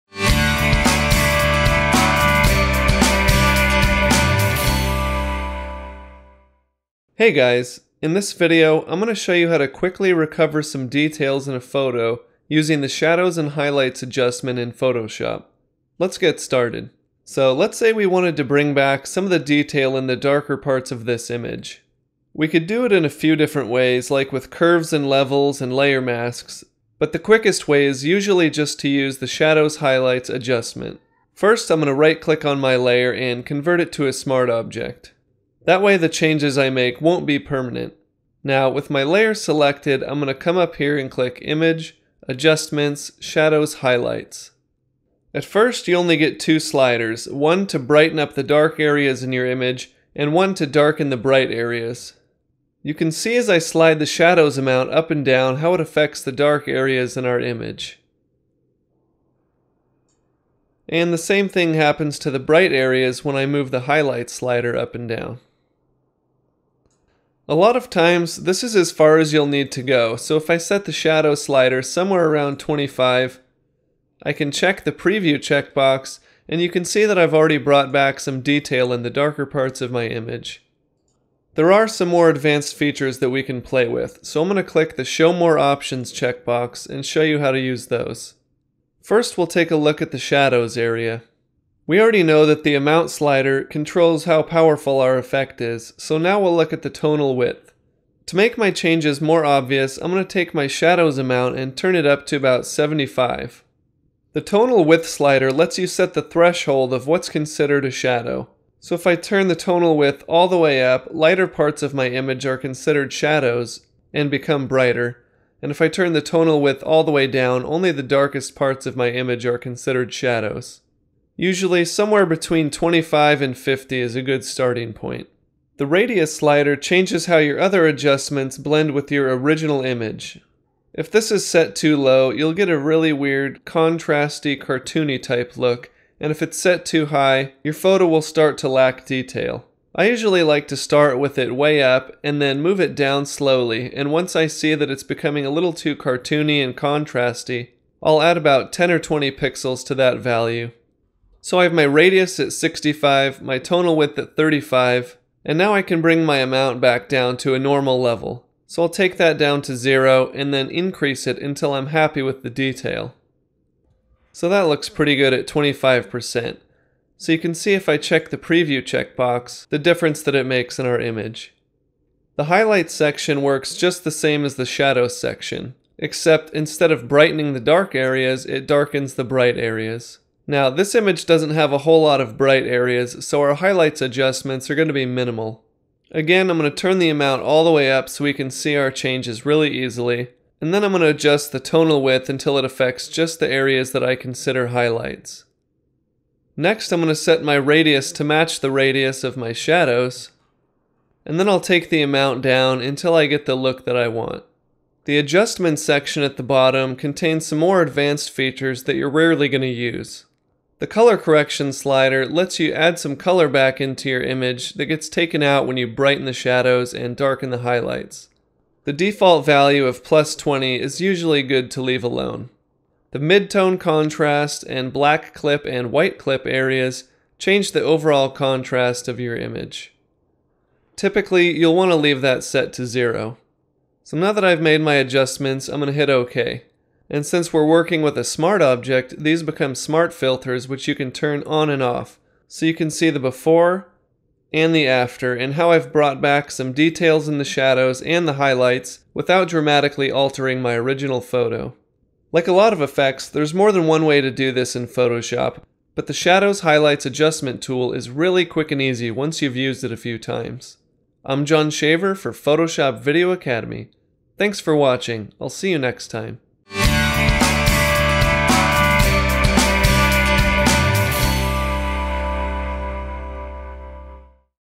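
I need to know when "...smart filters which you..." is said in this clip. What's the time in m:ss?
3:59.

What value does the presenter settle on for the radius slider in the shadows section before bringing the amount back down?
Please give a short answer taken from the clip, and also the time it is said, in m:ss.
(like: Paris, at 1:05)
65, at 2:32.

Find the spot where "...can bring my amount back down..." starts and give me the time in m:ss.
2:35.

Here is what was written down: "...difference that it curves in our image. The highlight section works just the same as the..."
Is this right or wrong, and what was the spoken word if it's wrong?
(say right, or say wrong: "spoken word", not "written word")
wrong: "makes", not "curves".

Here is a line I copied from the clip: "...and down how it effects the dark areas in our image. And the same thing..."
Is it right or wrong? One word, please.
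wrong.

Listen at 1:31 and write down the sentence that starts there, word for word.
We already know that the amount slider controls how powerful our effect is, so now we'll look at the tonal width.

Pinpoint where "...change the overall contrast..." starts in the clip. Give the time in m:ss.
3:47.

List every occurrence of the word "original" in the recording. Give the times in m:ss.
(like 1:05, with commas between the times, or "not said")
2:09, 4:10.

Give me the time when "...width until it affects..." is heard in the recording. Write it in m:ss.
3:12.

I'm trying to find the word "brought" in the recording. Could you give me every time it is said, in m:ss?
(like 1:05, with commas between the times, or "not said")
1:17, 4:05.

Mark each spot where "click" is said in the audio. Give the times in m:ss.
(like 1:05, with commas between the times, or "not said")
0:32, 0:41, 1:24.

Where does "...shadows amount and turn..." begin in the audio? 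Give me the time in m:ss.
1:40.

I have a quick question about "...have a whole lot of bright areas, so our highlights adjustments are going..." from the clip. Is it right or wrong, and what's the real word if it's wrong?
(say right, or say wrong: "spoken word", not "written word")
right.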